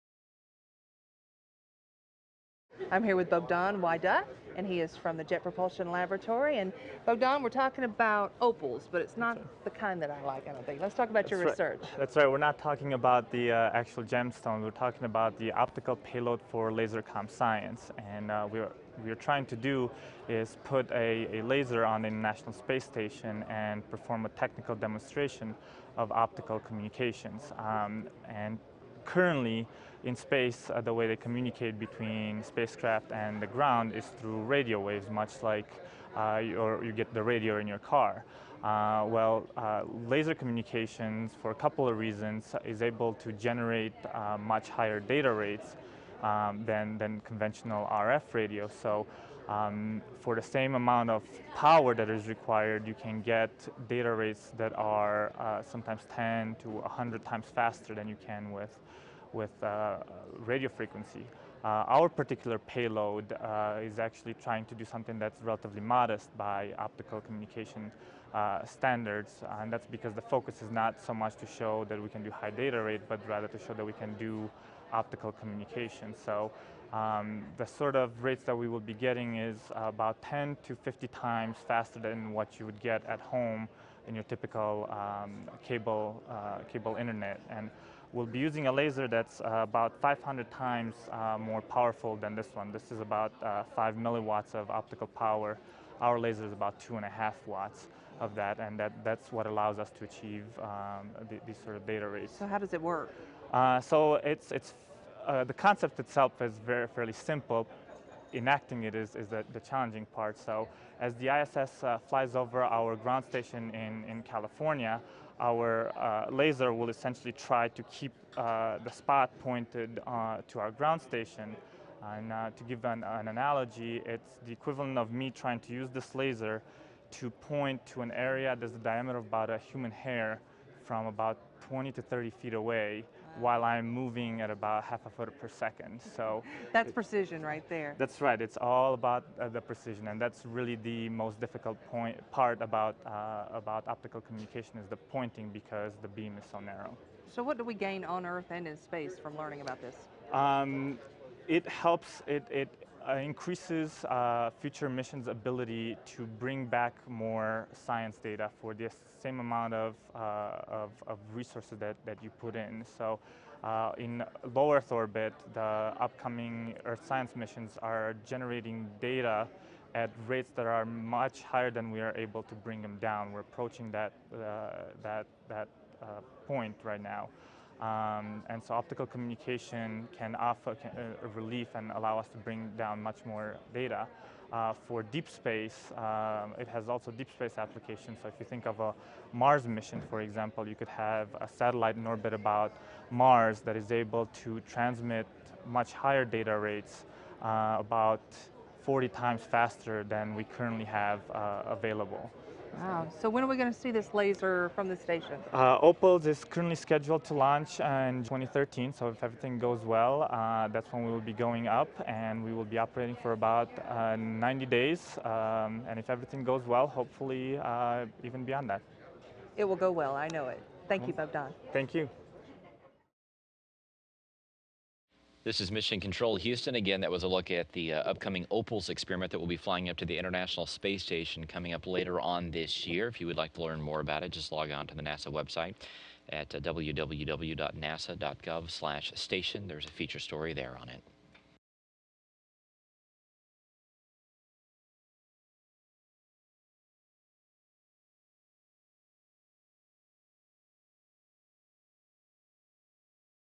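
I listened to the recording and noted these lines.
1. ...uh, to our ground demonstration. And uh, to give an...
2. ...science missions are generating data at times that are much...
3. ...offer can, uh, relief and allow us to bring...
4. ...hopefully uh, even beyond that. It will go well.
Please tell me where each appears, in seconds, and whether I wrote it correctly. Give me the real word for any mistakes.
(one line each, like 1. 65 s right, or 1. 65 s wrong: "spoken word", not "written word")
1. 120 s wrong: "station", not "demonstration"
2. 167 s wrong: "rates", not "times"
3. 180 s right
4. 216 s right.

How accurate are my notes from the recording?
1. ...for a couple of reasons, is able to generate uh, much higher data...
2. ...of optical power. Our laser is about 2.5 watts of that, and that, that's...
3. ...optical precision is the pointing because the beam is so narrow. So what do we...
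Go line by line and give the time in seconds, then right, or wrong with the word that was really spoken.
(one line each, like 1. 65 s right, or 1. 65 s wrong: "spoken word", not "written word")
1. 41 s right
2. 94 s right
3. 143 s wrong: "communication", not "precision".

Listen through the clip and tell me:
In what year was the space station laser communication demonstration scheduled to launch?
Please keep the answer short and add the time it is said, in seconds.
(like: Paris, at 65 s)
2013, at 208 s.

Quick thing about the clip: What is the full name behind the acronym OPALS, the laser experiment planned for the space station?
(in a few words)
Optical payload for laser com science.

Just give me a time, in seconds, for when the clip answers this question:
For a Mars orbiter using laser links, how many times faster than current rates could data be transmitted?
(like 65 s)
198 s.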